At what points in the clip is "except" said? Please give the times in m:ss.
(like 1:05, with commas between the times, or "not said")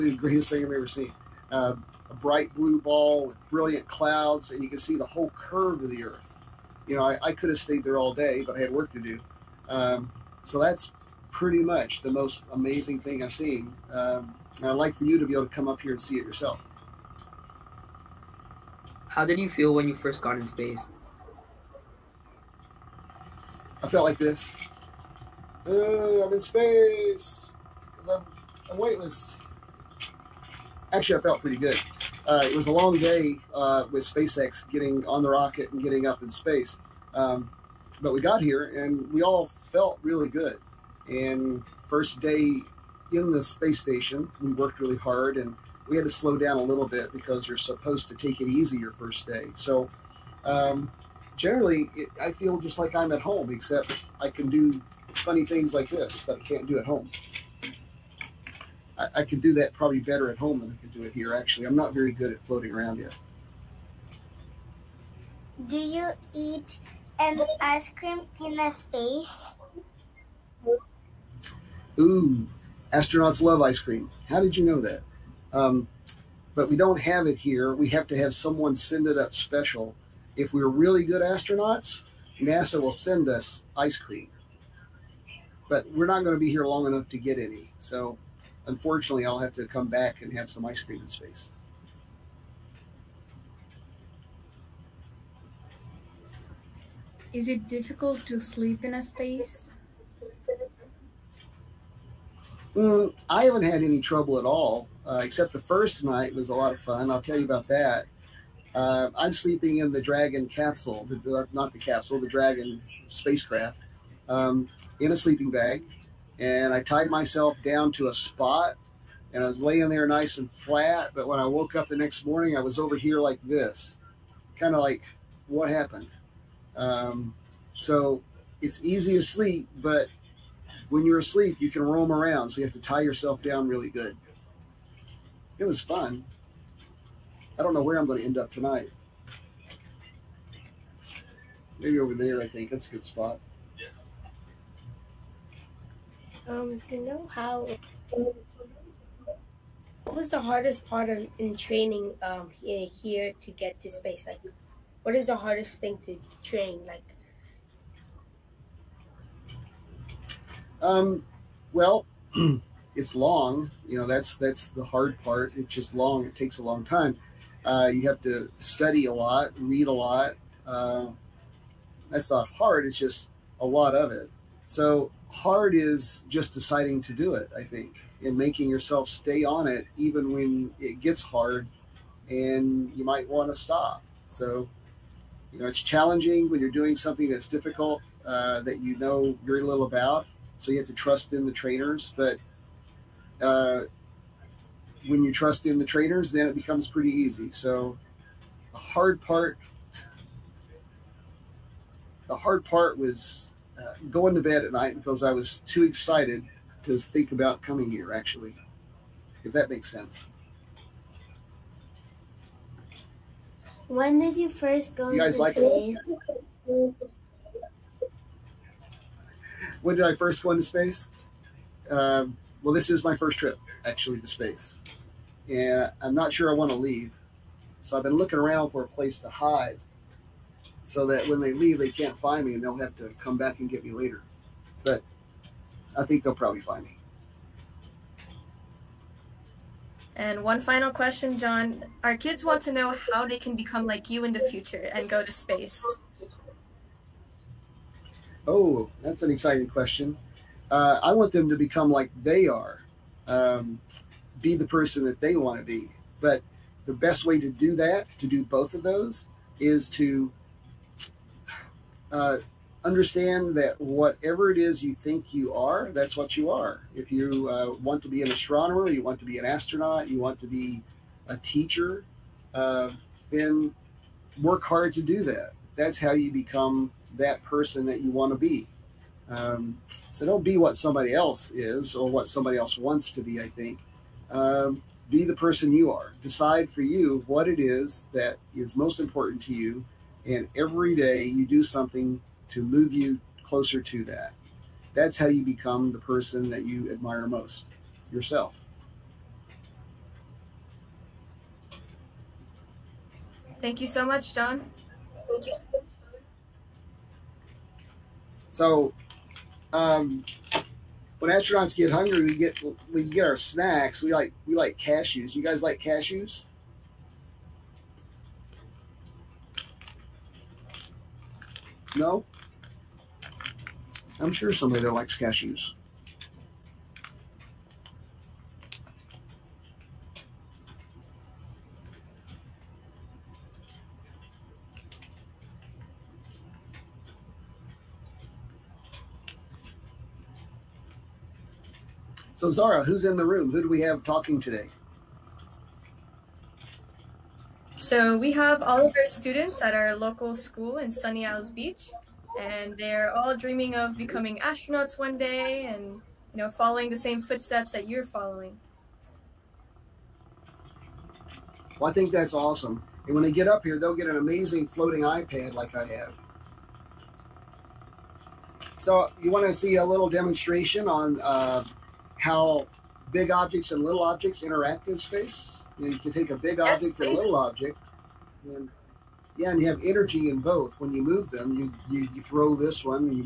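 0:53, 1:45.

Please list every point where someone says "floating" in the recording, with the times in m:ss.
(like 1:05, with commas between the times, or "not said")
1:02, 6:04.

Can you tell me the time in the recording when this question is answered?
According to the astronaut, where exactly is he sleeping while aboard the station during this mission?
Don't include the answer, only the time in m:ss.
1:52.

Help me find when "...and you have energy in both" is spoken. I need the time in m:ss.
6:19.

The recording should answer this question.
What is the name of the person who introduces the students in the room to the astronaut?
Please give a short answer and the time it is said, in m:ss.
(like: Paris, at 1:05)
Zara, at 5:42.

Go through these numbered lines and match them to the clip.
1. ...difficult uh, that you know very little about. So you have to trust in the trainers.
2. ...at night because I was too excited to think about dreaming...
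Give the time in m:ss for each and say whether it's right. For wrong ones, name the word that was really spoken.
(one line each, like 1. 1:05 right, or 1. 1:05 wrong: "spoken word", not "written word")
1. 3:07 right
2. 3:24 wrong: "coming", not "dreaming".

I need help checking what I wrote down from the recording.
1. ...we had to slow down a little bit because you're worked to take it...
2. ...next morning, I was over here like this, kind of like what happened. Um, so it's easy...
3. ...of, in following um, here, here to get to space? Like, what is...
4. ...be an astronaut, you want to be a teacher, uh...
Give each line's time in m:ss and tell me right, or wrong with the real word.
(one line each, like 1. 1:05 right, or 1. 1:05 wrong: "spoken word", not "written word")
1. 0:45 wrong: "supposed", not "worked"
2. 2:01 right
3. 2:31 wrong: "training", not "following"
4. 4:29 right.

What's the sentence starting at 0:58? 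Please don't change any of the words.
I, I can do that probably better at home than I can do it here.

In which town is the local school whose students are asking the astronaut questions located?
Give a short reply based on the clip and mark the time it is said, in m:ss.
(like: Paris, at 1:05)
Sunny Isles Beach, at 5:50.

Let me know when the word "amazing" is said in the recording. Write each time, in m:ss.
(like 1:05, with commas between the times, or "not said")
0:12, 6:04.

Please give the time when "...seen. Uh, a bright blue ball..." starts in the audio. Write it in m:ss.
0:00.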